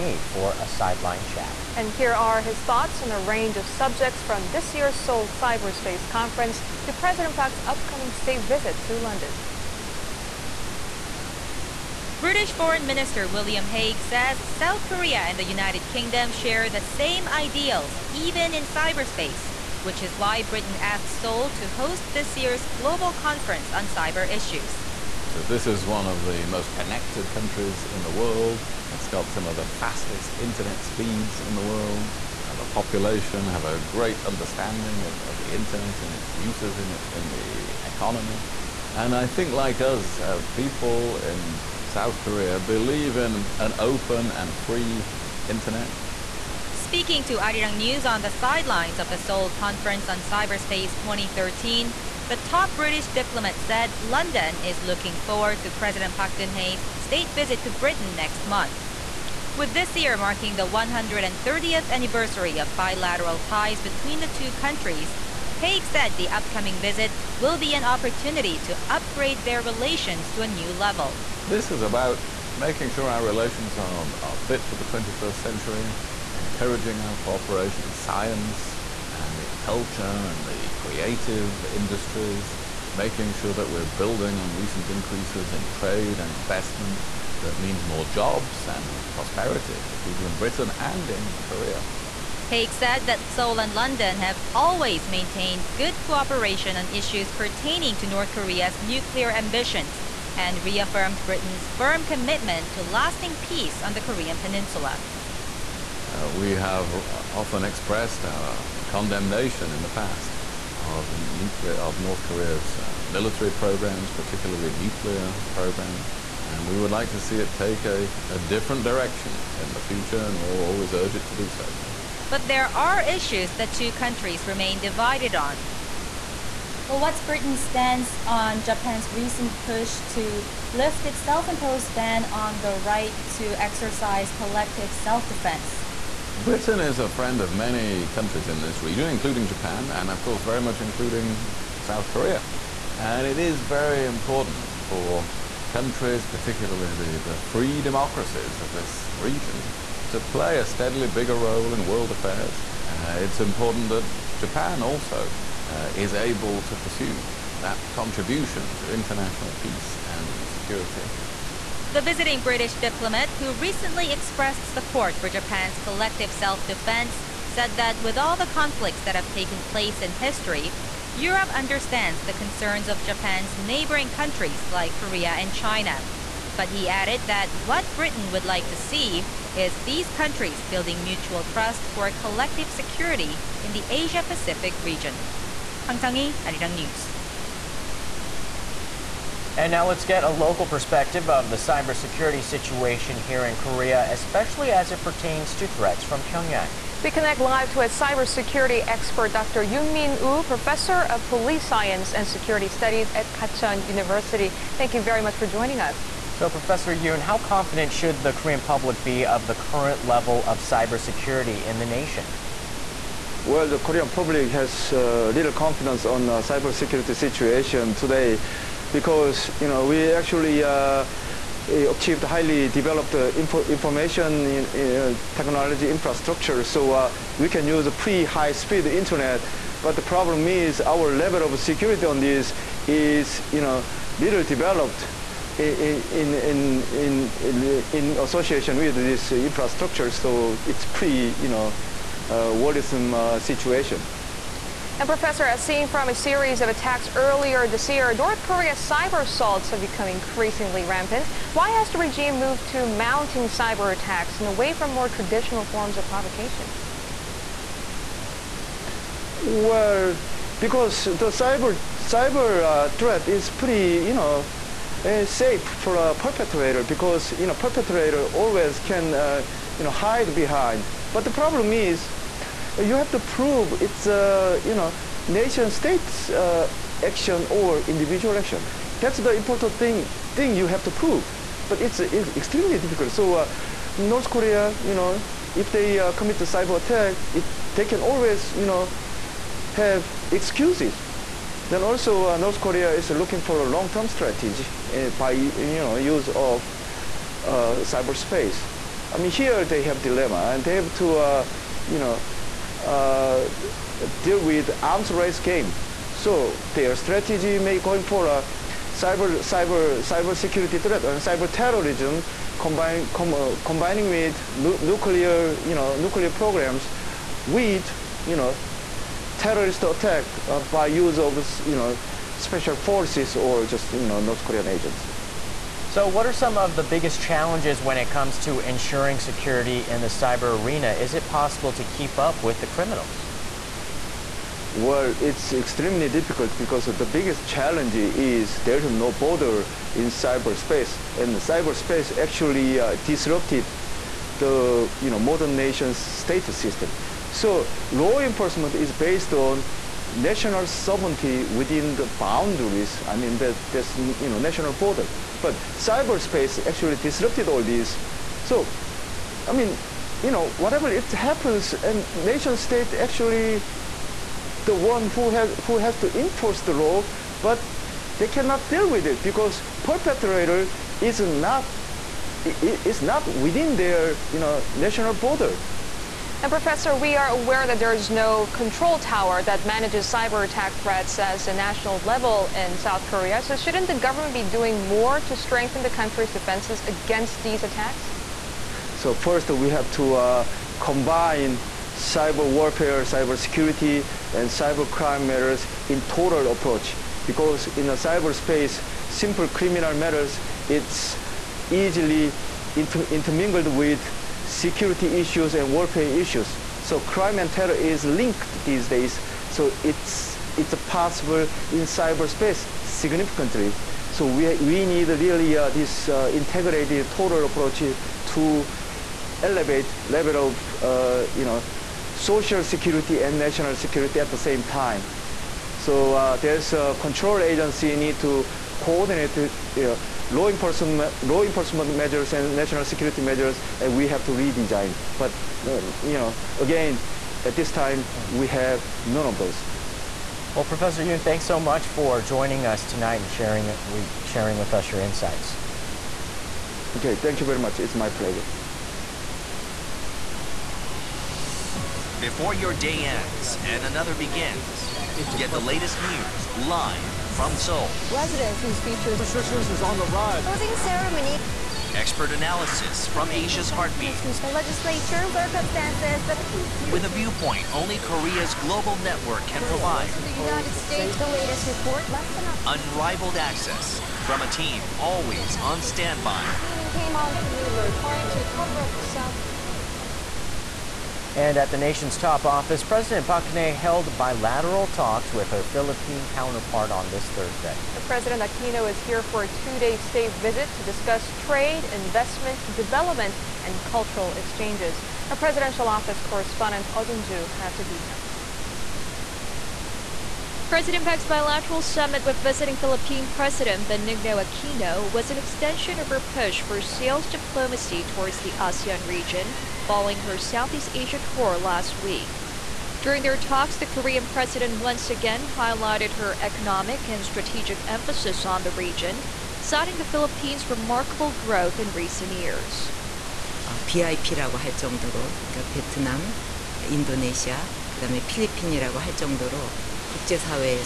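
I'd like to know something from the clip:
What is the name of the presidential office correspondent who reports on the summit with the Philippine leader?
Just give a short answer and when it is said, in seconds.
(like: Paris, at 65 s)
Oh Jin-ju, at 496 s.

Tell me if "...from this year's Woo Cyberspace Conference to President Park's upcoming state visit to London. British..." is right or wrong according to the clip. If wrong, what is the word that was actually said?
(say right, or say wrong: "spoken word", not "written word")
wrong: "Seoul", not "Woo".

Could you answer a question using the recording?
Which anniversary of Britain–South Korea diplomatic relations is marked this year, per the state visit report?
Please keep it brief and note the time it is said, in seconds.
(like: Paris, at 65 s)
130th, at 60 s.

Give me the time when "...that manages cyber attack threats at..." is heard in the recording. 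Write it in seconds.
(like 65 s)
379 s.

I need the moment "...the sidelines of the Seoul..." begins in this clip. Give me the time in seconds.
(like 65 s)
48 s.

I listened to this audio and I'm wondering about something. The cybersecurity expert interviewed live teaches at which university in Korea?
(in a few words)
Gachon University.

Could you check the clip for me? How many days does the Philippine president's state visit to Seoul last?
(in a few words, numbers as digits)
2.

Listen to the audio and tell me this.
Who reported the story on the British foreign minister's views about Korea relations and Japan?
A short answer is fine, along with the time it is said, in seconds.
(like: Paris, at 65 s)
Hwang Sang-hee, at 185 s.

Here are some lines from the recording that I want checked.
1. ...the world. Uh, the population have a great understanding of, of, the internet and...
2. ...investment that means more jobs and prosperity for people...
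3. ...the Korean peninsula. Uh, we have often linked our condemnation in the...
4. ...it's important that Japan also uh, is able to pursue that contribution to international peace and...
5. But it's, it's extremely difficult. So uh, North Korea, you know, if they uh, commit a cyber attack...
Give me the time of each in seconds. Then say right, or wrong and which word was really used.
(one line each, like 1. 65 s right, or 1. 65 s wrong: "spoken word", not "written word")
1. 31 s right
2. 86 s right
3. 103 s wrong: "expressed", not "linked"
4. 153 s right
5. 281 s right.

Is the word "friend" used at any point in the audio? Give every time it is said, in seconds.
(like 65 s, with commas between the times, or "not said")
137 s.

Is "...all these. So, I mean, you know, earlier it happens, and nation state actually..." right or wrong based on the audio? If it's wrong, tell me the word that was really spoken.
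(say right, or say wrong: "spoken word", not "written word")
wrong: "whatever", not "earlier".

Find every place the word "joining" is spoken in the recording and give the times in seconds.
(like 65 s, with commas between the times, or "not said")
205 s, 442 s.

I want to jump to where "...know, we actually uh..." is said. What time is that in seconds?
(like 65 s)
219 s.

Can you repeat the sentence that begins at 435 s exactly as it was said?
But uh, you know, again, at this time, hmm.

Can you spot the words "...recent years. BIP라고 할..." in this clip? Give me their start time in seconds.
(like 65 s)
521 s.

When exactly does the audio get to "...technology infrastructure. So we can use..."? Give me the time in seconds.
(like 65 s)
225 s.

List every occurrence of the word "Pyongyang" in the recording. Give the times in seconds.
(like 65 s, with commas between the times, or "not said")
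196 s.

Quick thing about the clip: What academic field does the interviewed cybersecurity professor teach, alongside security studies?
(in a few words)
Police science.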